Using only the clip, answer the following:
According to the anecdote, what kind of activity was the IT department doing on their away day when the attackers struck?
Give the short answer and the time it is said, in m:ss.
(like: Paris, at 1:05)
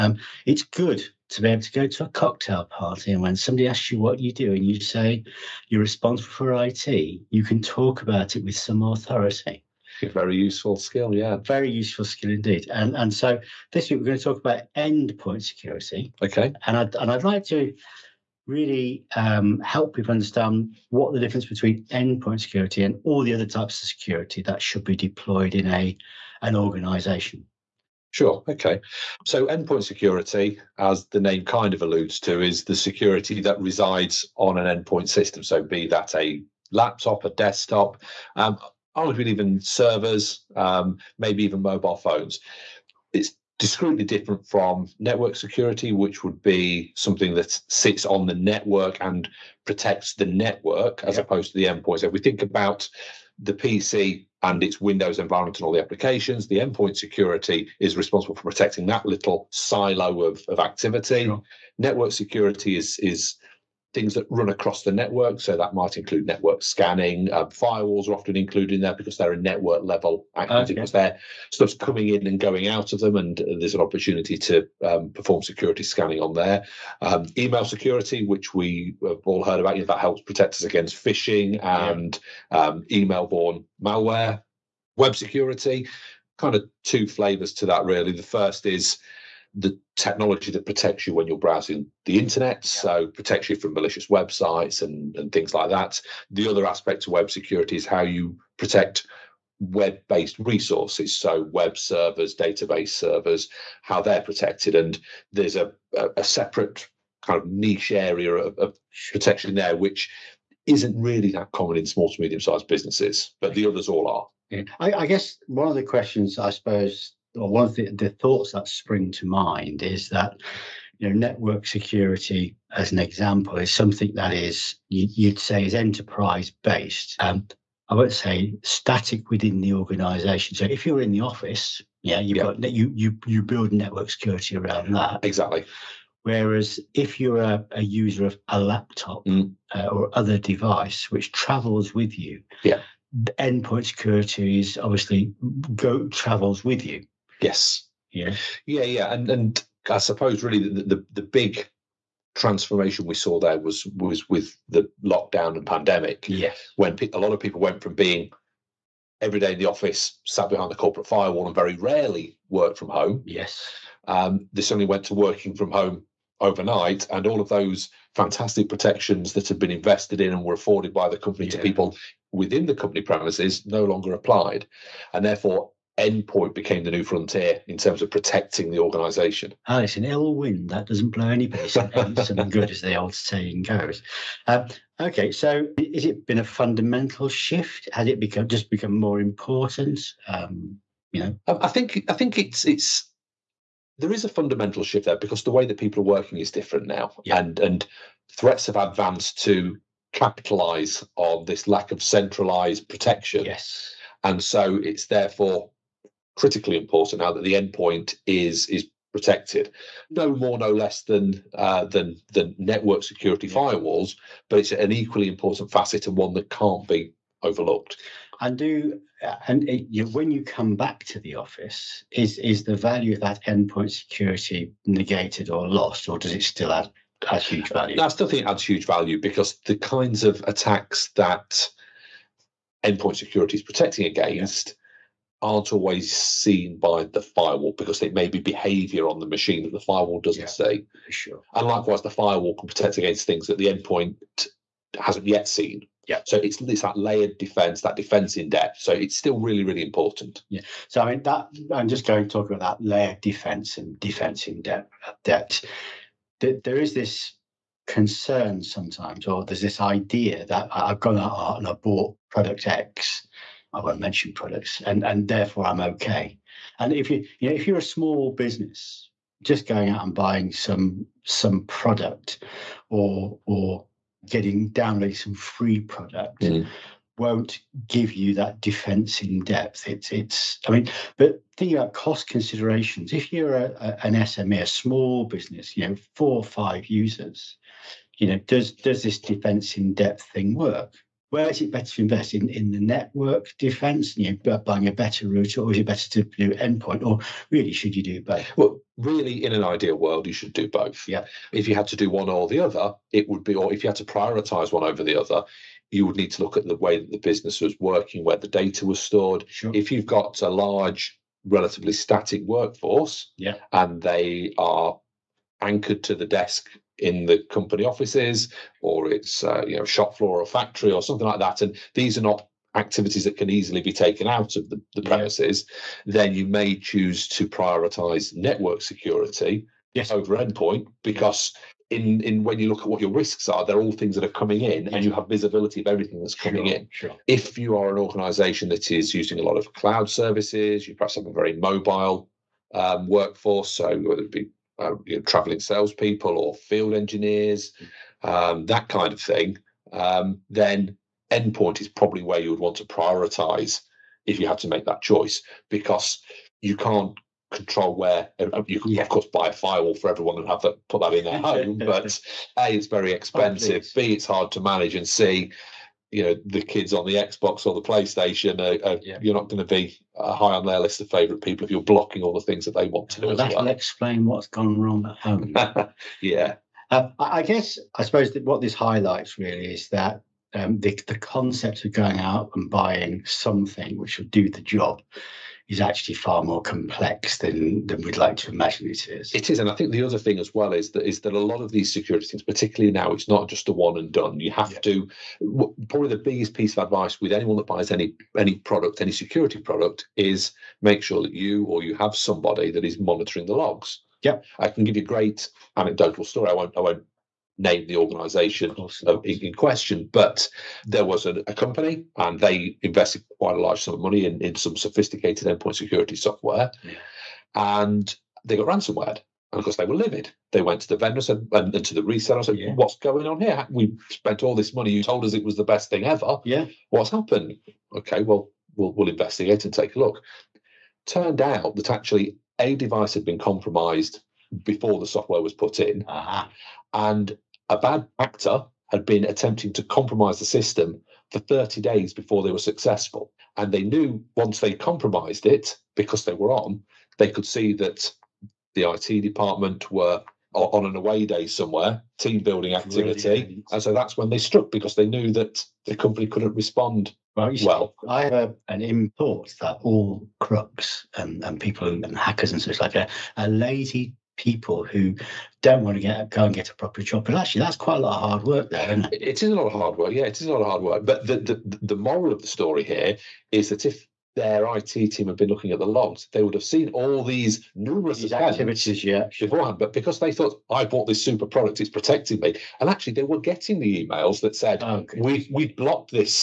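team building, at 7:32.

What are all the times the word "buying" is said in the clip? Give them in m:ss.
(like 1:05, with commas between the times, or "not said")
4:30, 4:54, 6:22.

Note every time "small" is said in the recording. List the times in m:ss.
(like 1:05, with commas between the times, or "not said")
1:51, 4:27, 4:44.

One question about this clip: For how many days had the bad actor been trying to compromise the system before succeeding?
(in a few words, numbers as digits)
30.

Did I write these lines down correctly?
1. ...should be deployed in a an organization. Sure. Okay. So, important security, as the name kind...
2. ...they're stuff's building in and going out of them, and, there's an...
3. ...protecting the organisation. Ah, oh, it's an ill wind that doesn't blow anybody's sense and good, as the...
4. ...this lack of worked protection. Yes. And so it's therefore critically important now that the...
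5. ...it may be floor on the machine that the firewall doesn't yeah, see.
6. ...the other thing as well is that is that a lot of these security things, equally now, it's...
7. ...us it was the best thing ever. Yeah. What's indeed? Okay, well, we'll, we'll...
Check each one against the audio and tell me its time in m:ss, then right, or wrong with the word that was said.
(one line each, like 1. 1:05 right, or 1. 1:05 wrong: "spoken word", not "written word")
1. 0:24 wrong: "endpoint", not "important"
2. 1:10 wrong: "coming", not "building"
3. 2:58 right
4. 3:21 wrong: "centralized", not "worked"
5. 3:57 wrong: "behavior", not "floor"
6. 6:29 wrong: "particularly", not "equally"
7. 7:05 wrong: "happened", not "indeed".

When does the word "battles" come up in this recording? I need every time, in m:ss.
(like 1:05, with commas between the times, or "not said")
not said.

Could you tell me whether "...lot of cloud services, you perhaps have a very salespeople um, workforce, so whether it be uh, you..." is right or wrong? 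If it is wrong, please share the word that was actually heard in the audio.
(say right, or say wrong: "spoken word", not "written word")
wrong: "mobile", not "salespeople".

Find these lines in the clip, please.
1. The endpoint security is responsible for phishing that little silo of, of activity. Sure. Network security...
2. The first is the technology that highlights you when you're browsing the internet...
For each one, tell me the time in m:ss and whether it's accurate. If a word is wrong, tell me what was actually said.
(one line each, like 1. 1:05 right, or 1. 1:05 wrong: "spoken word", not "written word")
1. 0:56 wrong: "protecting", not "phishing"
2. 1:28 wrong: "protects", not "highlights".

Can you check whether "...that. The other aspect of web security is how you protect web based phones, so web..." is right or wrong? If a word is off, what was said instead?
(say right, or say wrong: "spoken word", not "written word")
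wrong: "resources", not "phones".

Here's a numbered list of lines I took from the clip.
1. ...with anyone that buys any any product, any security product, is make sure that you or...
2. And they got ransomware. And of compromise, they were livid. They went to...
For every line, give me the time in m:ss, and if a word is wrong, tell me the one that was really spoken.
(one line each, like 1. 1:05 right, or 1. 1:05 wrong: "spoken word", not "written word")
1. 6:37 right
2. 6:57 wrong: "course", not "compromise".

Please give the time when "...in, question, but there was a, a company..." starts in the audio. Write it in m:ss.
6:49.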